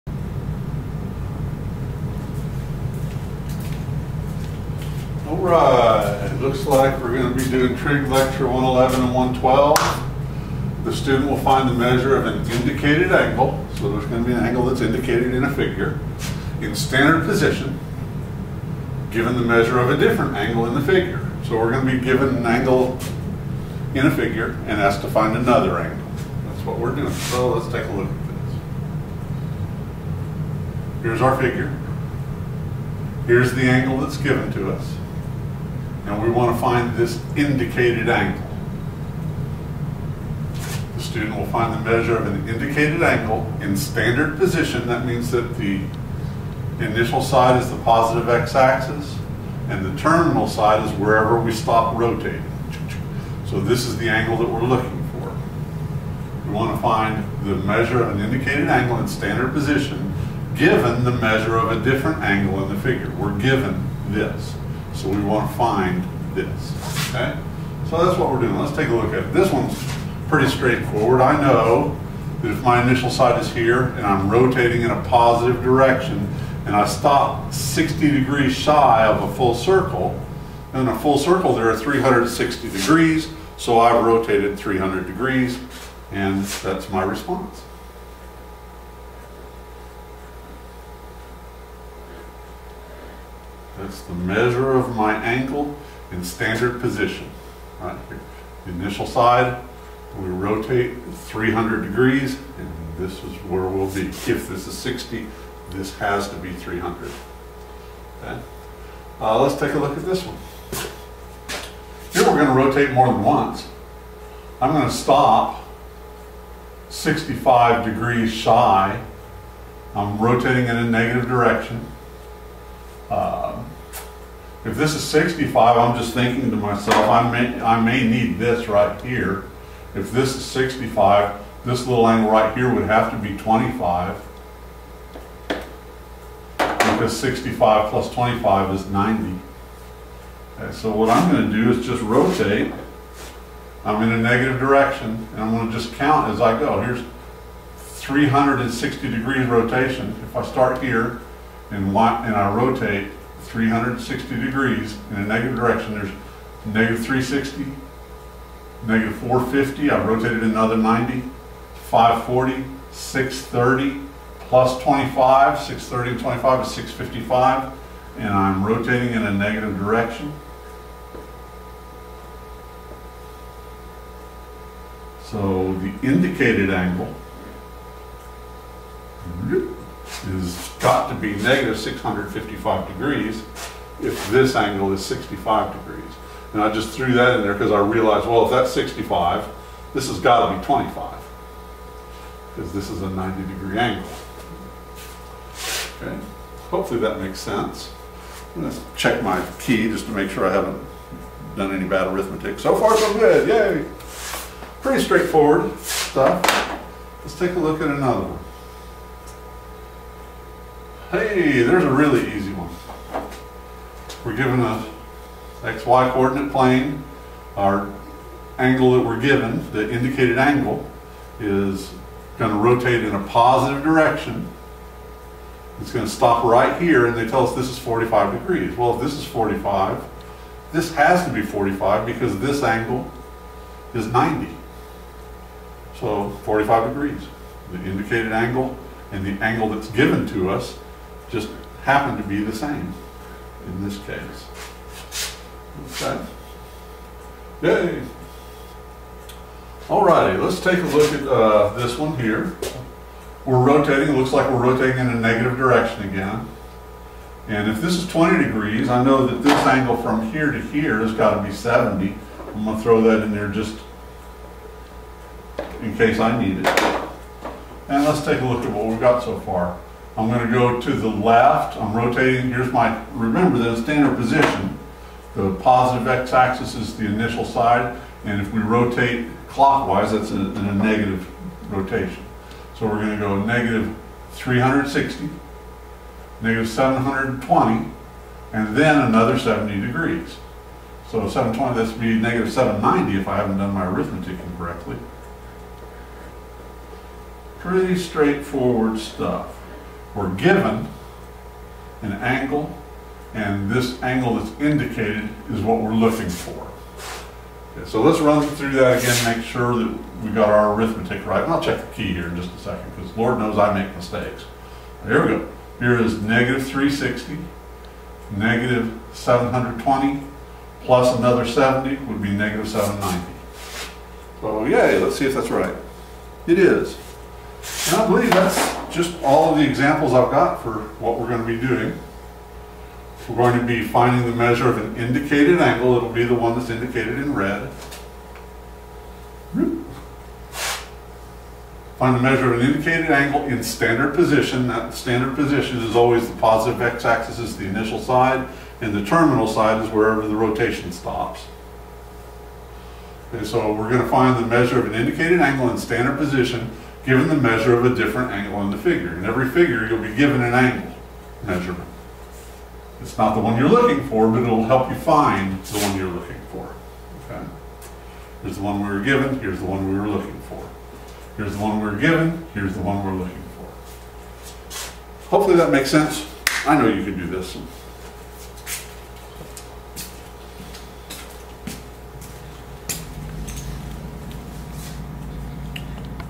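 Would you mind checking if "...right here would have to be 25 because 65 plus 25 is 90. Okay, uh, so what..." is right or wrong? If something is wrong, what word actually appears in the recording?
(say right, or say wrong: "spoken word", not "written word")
right.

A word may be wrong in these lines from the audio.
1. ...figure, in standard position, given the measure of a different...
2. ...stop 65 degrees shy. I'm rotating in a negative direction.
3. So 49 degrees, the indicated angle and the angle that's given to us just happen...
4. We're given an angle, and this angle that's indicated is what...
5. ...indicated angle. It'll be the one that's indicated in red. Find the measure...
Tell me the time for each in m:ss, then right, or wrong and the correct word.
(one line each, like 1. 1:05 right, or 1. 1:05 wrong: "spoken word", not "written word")
1. 0:15 right
2. 1:54 right
3. 3:55 wrong: "45", not "49"
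4. 5:00 right
5. 5:34 right.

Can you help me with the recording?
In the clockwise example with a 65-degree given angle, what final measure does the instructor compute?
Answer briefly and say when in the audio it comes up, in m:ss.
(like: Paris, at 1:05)
-655 degrees, at 3:01.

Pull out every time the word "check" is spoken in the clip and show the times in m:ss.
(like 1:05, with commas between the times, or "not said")
3:18, 5:11.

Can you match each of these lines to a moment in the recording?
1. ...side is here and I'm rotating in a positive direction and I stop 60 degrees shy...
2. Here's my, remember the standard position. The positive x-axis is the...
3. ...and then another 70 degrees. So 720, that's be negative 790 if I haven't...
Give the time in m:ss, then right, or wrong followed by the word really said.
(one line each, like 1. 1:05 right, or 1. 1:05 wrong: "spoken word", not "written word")
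1. 1:13 right
2. 4:32 right
3. 4:48 right.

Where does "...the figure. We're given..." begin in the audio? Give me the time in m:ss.
1:02.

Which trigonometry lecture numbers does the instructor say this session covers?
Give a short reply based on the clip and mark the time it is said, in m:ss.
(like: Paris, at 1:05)
111 and 112, at 0:08.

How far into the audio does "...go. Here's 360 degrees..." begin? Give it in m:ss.
2:26.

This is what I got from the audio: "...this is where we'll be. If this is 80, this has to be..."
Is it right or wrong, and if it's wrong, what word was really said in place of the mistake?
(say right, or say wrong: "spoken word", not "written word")
wrong: "60", not "80".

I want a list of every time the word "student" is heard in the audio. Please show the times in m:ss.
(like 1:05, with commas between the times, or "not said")
0:10, 0:41.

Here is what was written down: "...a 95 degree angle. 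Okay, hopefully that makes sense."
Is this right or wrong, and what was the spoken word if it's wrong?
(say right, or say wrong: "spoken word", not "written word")
wrong: "90", not "95".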